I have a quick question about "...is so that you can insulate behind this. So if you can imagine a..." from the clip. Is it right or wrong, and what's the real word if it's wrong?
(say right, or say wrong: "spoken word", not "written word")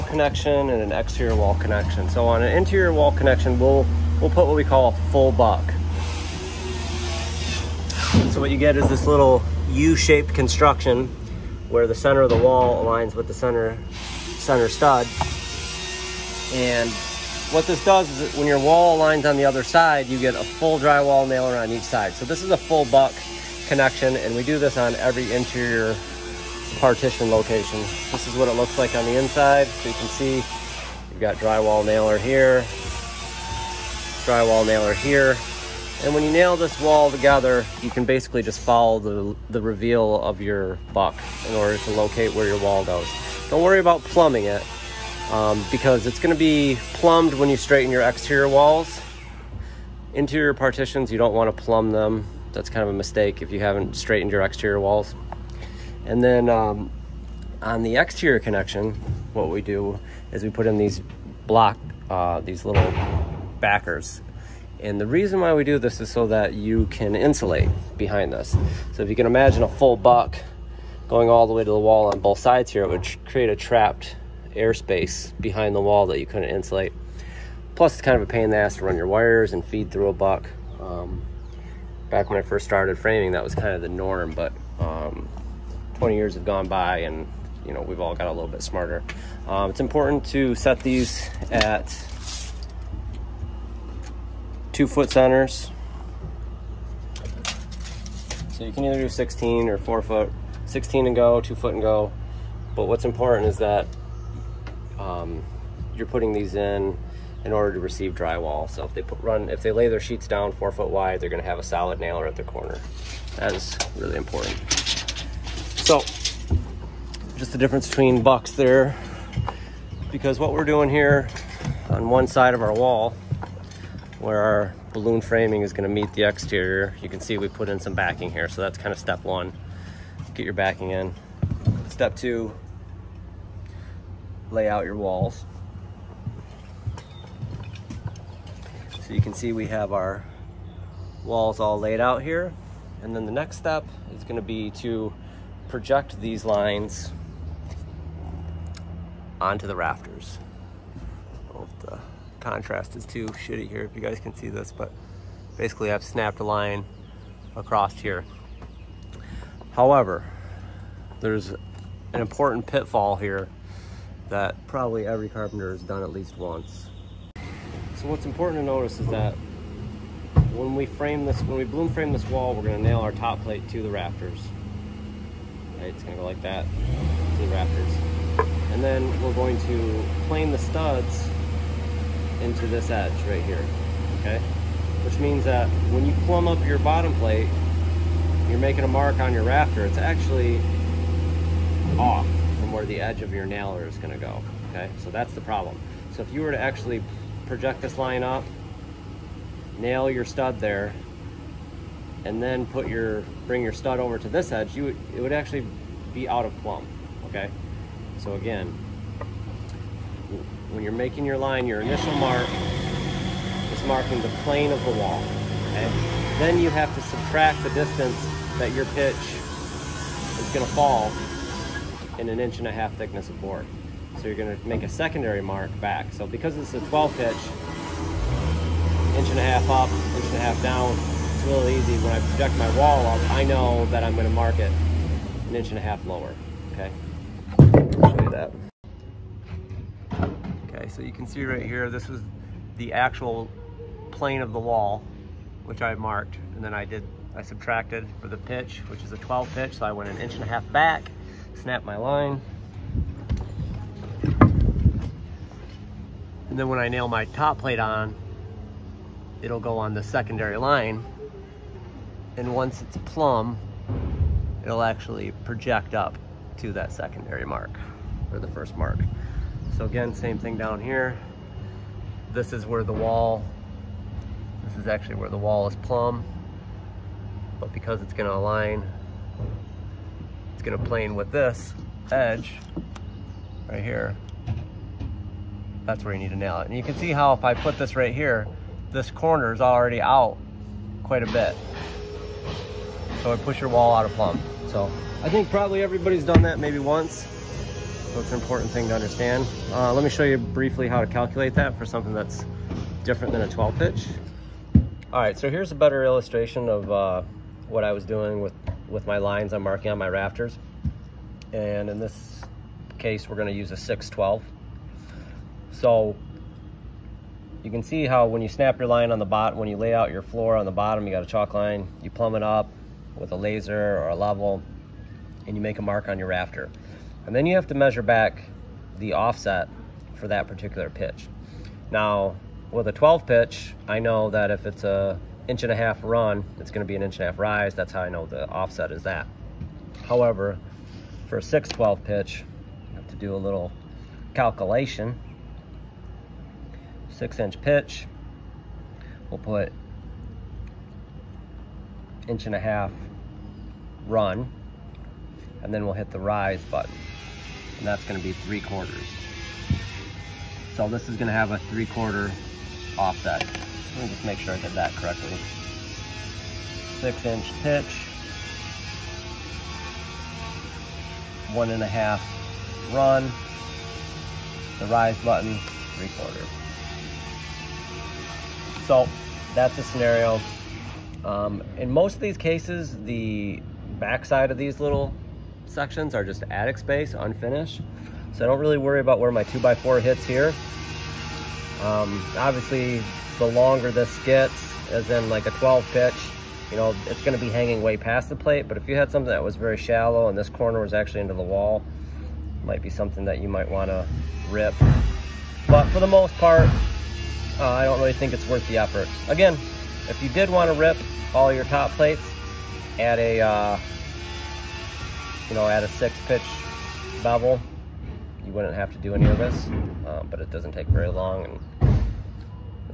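right.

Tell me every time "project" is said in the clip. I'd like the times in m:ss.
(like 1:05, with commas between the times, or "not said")
2:25, 3:17, 3:52, 4:25.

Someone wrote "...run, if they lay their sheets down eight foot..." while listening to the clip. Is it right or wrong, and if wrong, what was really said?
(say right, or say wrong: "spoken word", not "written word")
wrong: "four", not "eight".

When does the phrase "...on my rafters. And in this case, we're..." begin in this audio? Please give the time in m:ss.
5:09.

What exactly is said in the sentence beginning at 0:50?
Interior partitions, you don't wanna plumb them.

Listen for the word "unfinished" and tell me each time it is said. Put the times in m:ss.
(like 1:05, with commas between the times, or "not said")
6:27.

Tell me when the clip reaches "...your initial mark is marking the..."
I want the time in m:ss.
3:31.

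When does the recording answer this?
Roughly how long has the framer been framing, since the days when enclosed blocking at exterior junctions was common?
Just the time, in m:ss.
1:25.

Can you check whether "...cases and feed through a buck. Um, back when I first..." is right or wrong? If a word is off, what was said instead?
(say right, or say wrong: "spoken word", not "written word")
wrong: "wires", not "cases".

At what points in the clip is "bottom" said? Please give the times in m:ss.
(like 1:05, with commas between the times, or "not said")
3:06, 5:20.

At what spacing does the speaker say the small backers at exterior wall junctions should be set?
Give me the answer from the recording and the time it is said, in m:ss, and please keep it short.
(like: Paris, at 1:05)
2 foot centers, at 1:34.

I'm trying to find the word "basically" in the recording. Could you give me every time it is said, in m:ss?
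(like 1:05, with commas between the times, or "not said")
0:38, 2:35.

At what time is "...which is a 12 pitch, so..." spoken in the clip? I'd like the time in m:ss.
4:08.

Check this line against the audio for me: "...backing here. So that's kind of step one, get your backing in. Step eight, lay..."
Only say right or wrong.
wrong.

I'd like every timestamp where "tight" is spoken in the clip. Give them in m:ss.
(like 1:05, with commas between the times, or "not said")
not said.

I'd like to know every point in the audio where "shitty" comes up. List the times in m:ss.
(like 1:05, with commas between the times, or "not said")
2:33.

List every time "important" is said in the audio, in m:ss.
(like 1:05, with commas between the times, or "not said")
1:29, 1:43, 1:54, 2:42, 2:48, 4:58.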